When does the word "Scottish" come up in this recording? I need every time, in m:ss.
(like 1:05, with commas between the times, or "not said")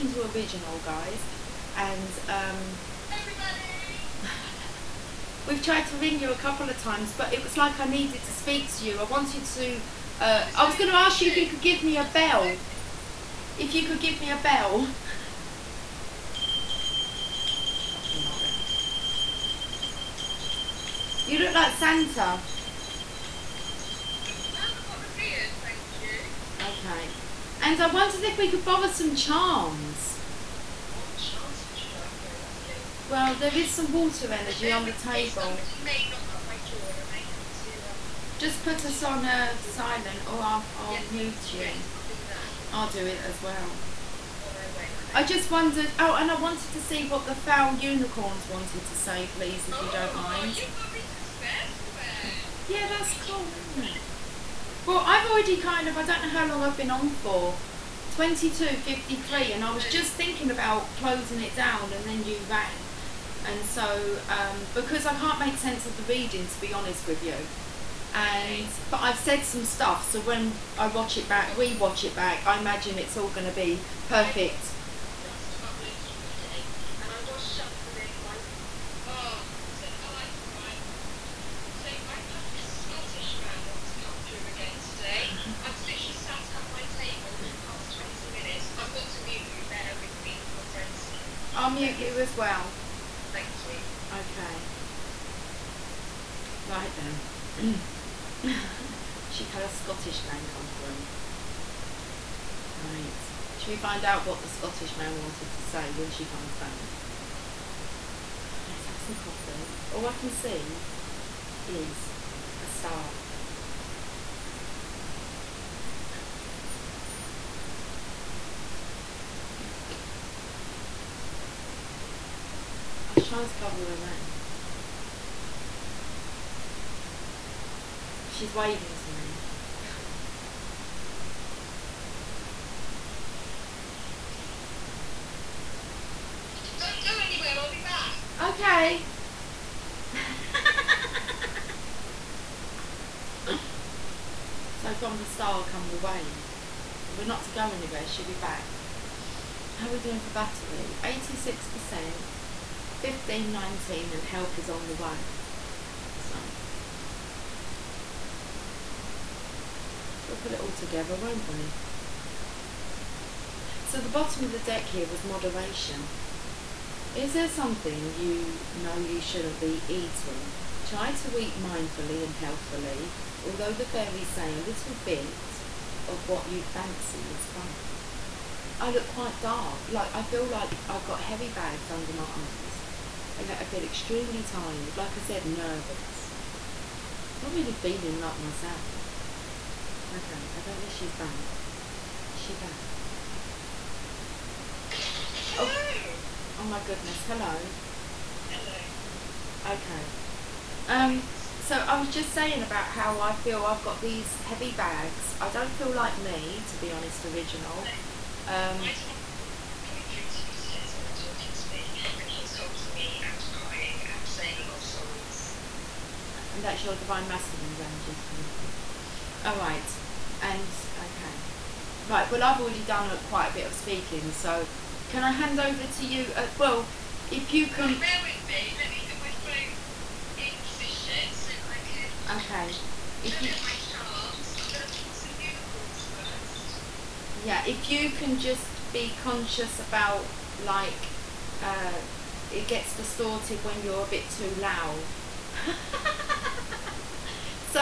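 1:22, 1:39, 1:44.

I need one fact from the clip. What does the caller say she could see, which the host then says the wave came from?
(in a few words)
A star.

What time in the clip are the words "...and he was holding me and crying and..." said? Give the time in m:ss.
3:32.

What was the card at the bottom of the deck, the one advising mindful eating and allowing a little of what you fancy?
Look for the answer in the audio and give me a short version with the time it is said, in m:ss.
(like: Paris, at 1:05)
Moderation, at 2:45.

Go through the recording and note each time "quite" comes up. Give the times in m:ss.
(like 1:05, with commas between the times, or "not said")
2:59, 3:43.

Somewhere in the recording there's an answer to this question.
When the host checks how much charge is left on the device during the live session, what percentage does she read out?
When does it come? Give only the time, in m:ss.
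2:31.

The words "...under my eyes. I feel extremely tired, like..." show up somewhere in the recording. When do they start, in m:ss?
3:01.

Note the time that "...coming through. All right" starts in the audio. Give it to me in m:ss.
3:38.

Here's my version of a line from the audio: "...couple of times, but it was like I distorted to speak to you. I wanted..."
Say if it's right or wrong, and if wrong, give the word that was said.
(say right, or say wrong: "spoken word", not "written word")
wrong: "needed", not "distorted".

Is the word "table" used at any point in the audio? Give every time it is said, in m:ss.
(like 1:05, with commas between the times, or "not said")
0:34, 1:26.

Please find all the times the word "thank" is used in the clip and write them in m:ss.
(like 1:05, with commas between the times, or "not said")
0:26, 1:33.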